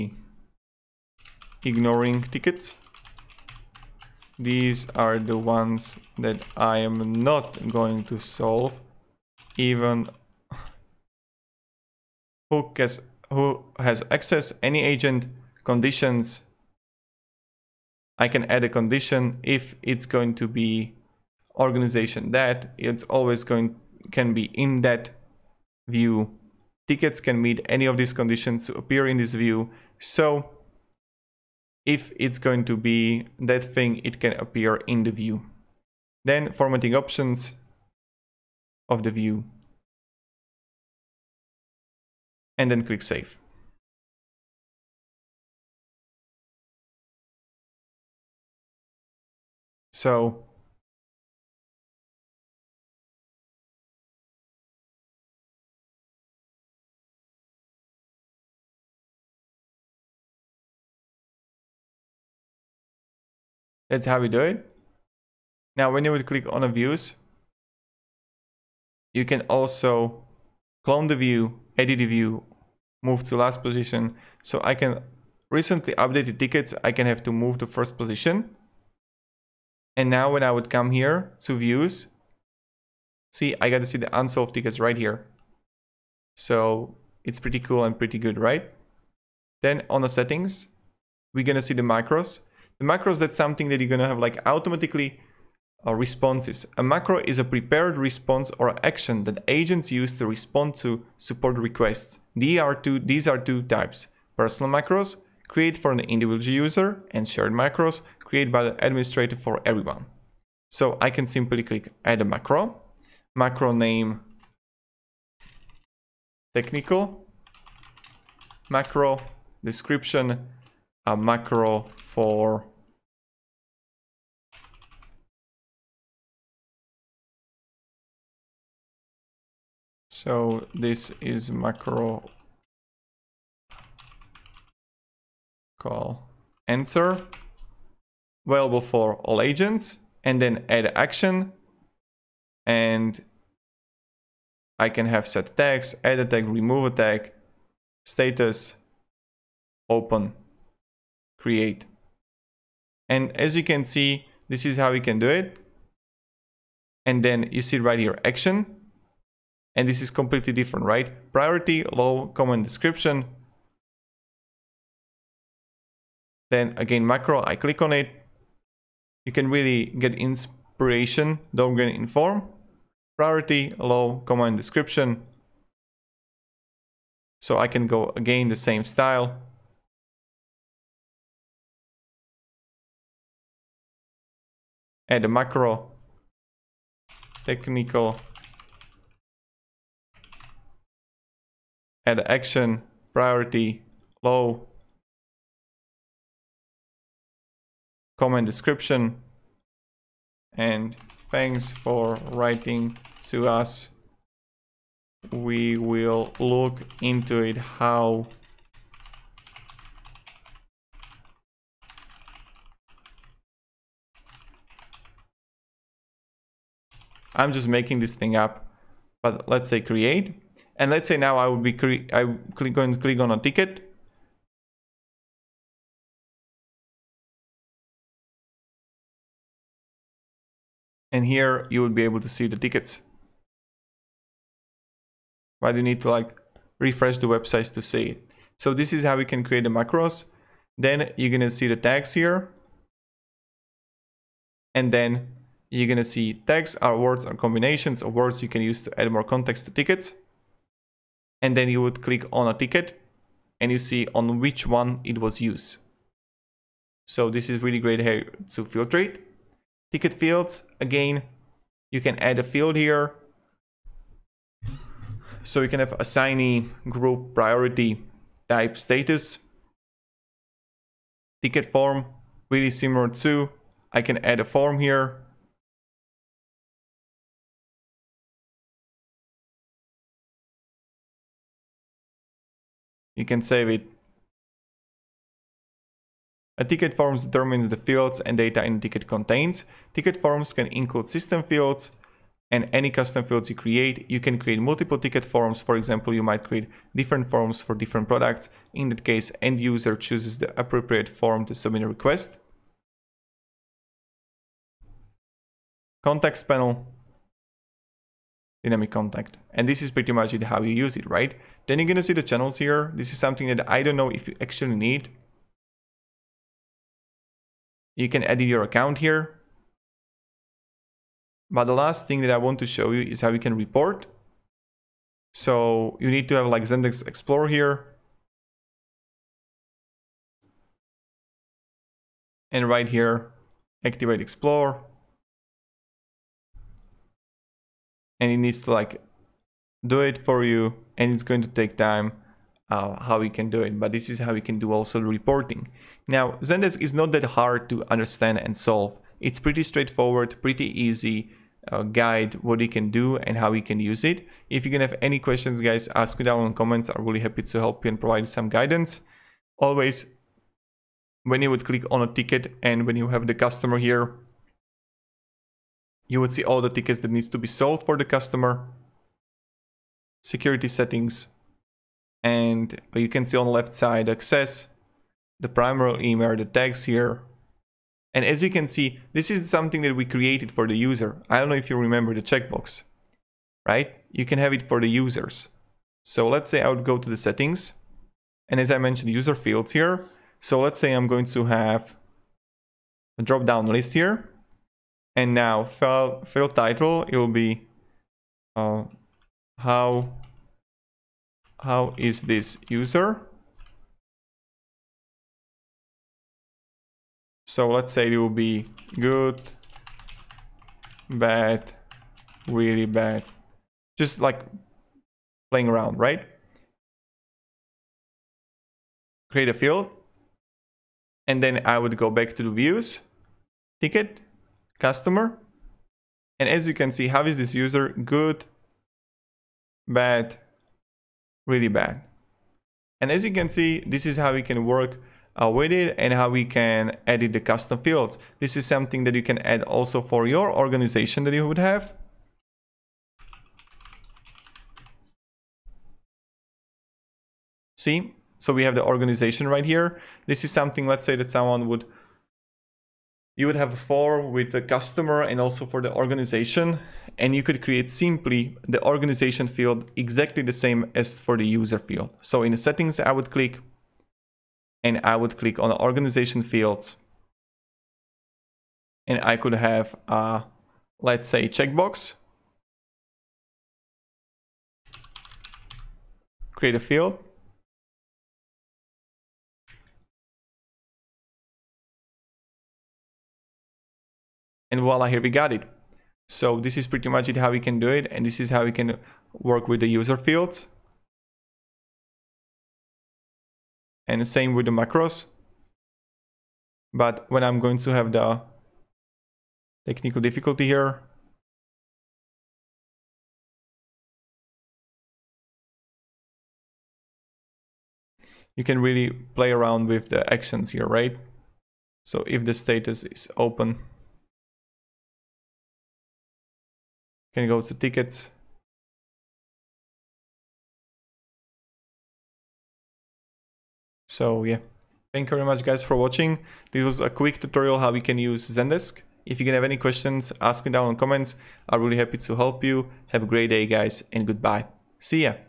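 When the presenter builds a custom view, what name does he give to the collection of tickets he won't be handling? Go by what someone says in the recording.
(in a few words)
Ignoring tickets.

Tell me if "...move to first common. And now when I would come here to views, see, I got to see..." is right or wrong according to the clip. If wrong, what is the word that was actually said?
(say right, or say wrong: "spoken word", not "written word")
wrong: "position", not "common".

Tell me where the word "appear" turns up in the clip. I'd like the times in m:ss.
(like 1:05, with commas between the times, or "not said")
0:28, 0:34.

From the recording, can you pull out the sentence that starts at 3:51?
And here you would be able to see the tickets.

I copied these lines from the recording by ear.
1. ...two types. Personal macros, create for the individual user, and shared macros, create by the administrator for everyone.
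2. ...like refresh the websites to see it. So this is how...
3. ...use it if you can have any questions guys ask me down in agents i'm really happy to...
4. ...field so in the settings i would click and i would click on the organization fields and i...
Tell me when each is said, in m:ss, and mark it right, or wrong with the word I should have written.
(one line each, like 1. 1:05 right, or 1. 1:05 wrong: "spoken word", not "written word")
1. 1:43 right
2. 3:56 right
3. 5:53 wrong: "comments", not "agents"
4. 7:41 right.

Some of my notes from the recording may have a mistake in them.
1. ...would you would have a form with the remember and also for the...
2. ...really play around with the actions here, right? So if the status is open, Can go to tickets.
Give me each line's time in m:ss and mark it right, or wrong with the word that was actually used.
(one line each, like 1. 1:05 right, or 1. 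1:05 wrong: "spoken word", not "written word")
1. 7:31 wrong: "customer", not "remember"
2. 8:28 right.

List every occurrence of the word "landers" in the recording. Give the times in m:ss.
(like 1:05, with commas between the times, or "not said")
not said.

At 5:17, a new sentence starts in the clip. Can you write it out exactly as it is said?
You can edit your account here.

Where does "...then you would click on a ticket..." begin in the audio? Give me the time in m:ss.
4:11.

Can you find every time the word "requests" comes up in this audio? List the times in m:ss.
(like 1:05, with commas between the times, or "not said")
1:41, 5:01.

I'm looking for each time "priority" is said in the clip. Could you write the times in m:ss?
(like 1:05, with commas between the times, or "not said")
2:41, 2:53, 3:13, 4:27.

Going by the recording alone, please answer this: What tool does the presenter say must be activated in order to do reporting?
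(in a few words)
Zendesk Explorer.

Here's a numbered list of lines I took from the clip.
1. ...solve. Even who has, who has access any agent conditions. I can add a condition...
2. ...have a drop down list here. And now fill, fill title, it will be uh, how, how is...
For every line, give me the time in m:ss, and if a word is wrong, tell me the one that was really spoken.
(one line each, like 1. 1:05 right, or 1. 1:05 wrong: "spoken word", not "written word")
1. 0:08 right
2. 6:31 right.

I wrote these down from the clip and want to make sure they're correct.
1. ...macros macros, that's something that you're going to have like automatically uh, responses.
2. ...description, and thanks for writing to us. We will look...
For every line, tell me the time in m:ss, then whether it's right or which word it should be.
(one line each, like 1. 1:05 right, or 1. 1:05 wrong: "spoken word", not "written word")
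1. 1:31 right
2. 3:18 right.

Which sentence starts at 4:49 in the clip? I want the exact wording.
Ticket forms can include system fields and any custom fields you create.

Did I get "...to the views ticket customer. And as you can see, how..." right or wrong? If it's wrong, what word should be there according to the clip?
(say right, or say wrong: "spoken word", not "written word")
right.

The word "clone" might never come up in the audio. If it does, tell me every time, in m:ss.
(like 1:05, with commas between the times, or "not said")
1:10.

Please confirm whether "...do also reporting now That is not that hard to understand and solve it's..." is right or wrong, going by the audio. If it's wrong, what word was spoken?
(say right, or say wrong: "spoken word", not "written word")
wrong: "Zendesk", not "That".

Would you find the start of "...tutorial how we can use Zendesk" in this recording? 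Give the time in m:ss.
8:47.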